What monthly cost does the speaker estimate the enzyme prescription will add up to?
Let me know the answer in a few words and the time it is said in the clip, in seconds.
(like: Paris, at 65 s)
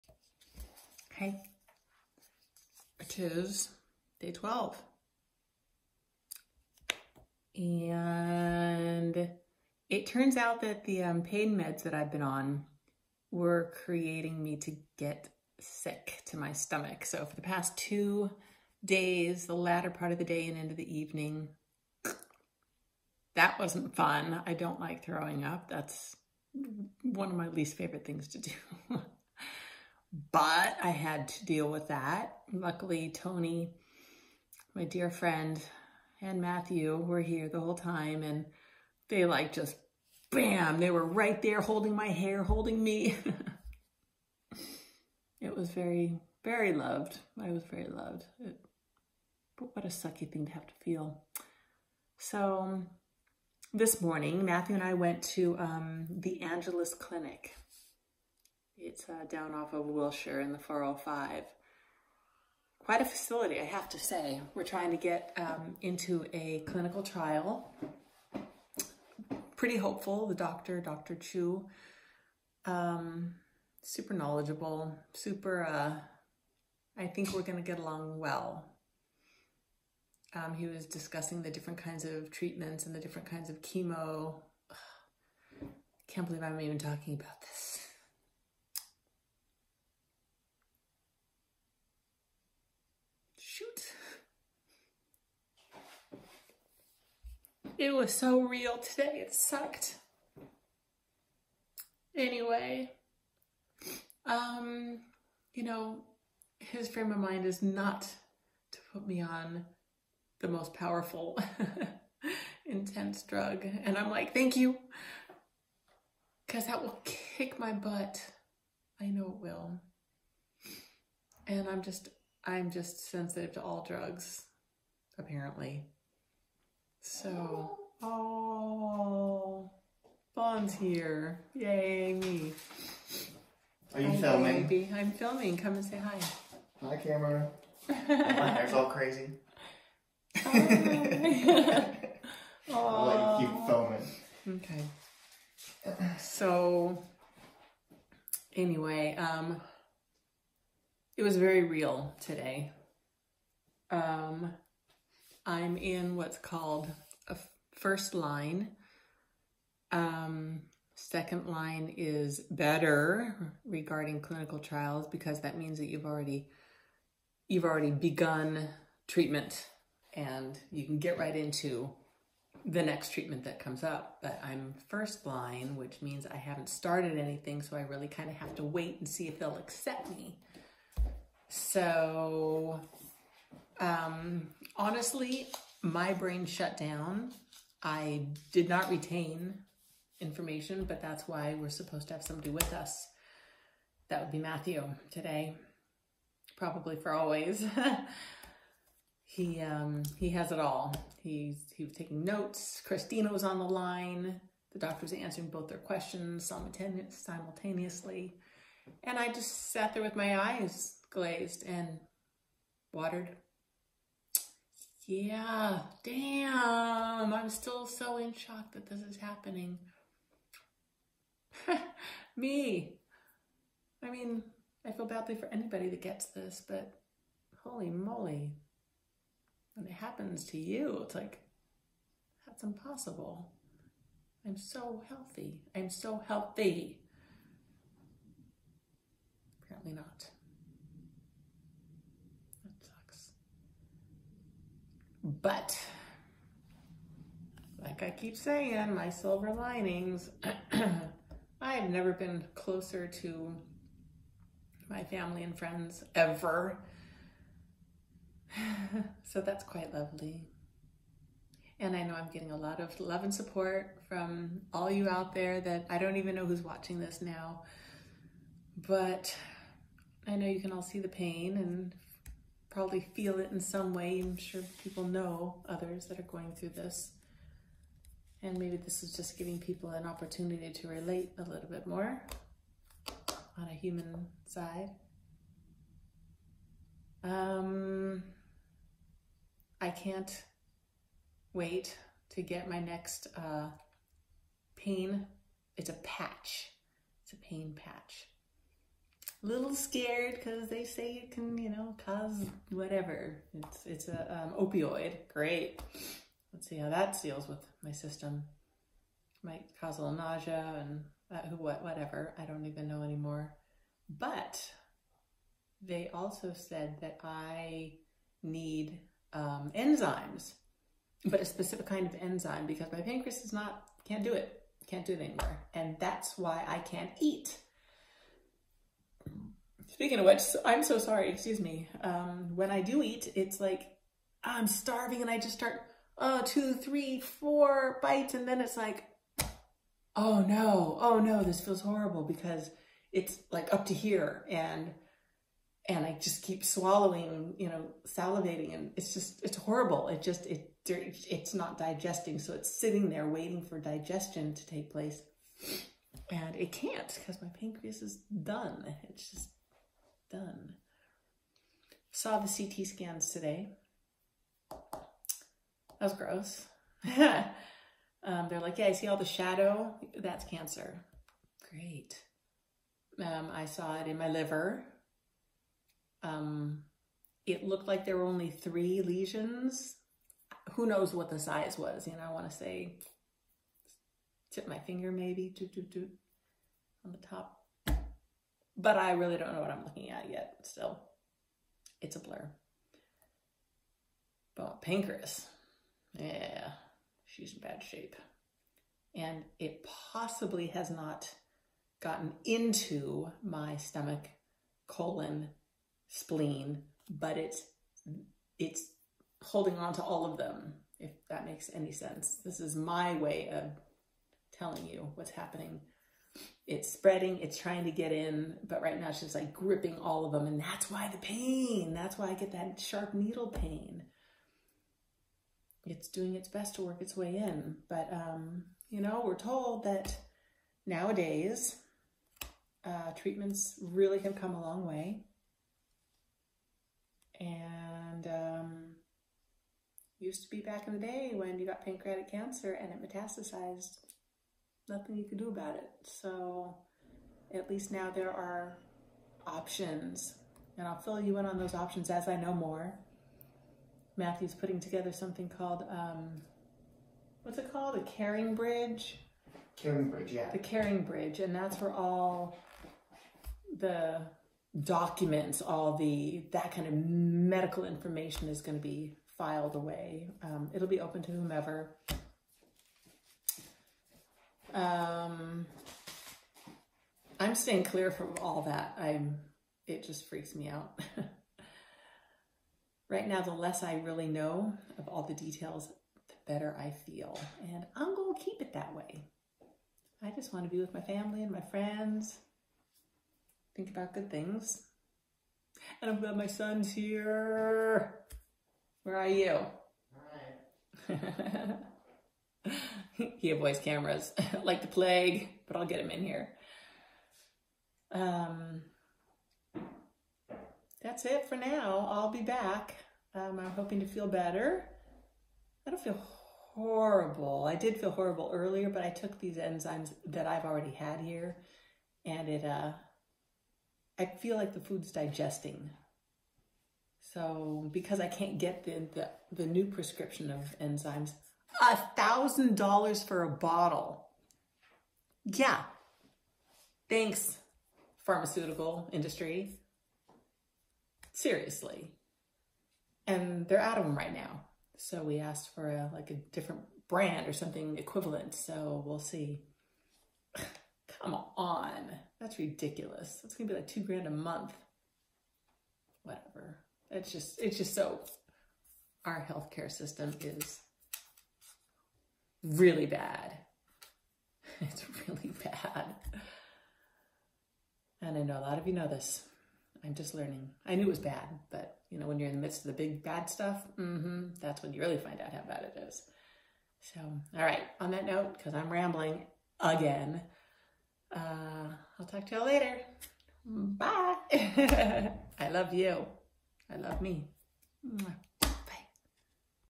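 $2,000, at 553 s.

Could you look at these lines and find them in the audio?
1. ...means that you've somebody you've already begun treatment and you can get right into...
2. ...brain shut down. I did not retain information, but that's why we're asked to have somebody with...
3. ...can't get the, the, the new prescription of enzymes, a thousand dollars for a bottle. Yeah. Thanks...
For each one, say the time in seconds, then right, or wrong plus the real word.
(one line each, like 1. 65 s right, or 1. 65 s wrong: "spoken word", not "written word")
1. 165 s wrong: "already", not "somebody"
2. 186 s wrong: "supposed", not "asked"
3. 528 s right.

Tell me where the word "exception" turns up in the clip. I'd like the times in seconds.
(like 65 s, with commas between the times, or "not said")
not said.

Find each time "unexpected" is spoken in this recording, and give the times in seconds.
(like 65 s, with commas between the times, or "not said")
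not said.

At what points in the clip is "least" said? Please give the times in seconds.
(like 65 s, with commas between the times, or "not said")
27 s, 447 s.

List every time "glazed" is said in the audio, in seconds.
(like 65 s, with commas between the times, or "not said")
211 s.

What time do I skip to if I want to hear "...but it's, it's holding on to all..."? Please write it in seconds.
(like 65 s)
407 s.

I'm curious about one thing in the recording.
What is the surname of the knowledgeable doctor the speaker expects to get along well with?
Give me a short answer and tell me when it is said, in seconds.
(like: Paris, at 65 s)
Chu, at 71 s.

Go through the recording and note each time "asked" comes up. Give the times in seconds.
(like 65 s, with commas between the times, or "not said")
545 s.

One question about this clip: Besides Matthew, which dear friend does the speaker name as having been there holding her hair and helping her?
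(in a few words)
Tony.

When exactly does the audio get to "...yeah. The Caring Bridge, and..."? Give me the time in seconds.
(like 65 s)
460 s.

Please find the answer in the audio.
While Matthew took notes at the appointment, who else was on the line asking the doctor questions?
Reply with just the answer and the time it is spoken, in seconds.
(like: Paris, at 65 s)
Christina, at 202 s.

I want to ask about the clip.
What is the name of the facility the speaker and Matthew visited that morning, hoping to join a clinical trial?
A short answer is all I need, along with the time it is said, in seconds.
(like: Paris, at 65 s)
Angeles Clinic, at 56 s.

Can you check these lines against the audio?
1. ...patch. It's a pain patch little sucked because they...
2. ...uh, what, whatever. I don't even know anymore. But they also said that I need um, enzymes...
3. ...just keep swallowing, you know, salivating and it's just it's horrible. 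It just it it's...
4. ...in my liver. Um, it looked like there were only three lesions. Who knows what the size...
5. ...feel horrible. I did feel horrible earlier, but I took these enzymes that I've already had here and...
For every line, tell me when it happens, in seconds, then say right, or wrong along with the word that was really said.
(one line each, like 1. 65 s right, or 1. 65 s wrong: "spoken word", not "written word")
1. 296 s wrong: "scared", not "sucked"
2. 311 s right
3. 346 s right
4. 374 s right
5. 516 s right.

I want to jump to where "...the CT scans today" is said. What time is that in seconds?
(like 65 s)
362 s.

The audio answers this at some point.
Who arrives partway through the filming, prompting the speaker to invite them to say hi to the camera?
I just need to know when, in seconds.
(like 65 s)
130 s.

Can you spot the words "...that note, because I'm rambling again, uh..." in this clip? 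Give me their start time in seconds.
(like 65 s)
578 s.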